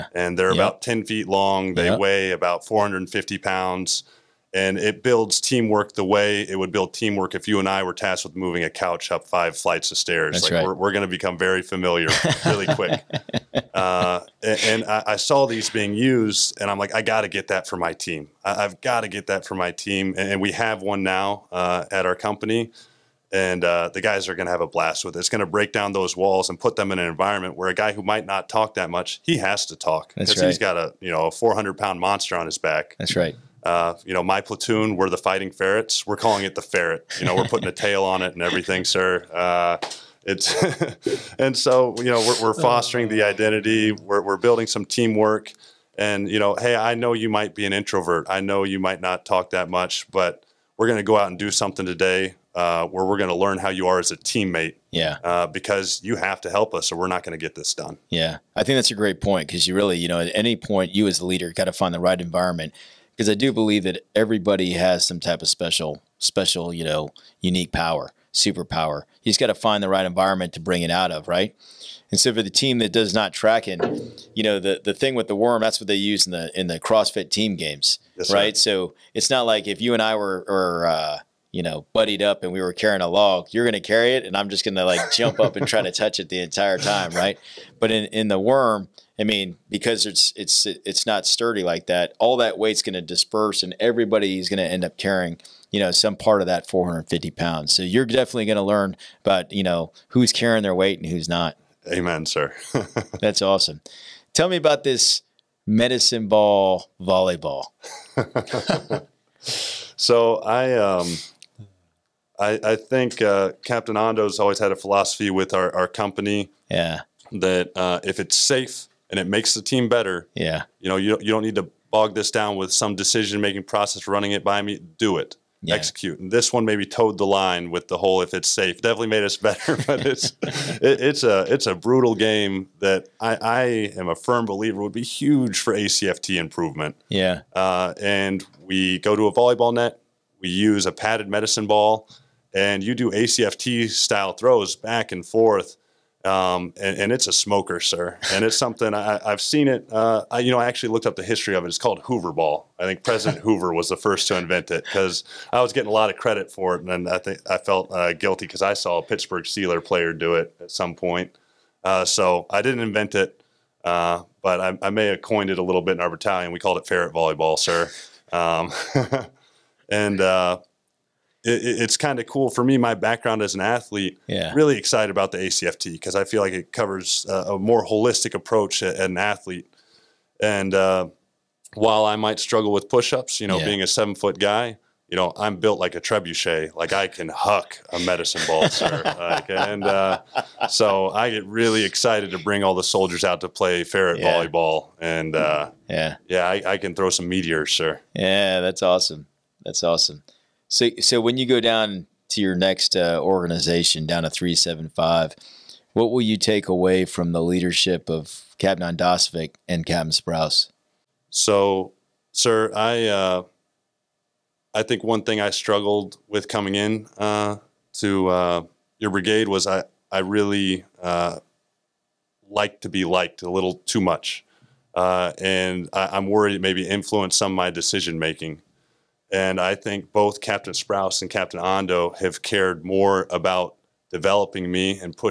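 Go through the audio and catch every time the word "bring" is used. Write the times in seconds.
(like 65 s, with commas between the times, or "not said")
70 s, 192 s.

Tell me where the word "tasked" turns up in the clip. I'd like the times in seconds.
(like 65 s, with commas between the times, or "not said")
7 s.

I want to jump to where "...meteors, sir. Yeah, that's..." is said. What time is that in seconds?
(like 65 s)
197 s.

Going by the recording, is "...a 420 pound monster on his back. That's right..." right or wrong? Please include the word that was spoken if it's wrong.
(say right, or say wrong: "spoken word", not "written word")
wrong: "400", not "420".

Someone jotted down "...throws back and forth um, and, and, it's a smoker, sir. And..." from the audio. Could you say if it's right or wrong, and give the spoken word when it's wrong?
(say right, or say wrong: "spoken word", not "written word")
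right.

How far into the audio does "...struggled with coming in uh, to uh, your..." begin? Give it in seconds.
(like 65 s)
215 s.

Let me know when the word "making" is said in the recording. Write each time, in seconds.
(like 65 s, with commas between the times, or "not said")
123 s, 228 s.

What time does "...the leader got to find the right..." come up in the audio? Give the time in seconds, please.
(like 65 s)
61 s.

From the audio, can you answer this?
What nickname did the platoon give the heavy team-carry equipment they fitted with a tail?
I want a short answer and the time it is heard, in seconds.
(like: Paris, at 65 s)
the ferret, at 36 s.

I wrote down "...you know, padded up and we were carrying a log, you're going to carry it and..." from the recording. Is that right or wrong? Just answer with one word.
wrong.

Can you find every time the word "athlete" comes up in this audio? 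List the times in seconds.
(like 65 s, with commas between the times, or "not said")
173 s, 179 s.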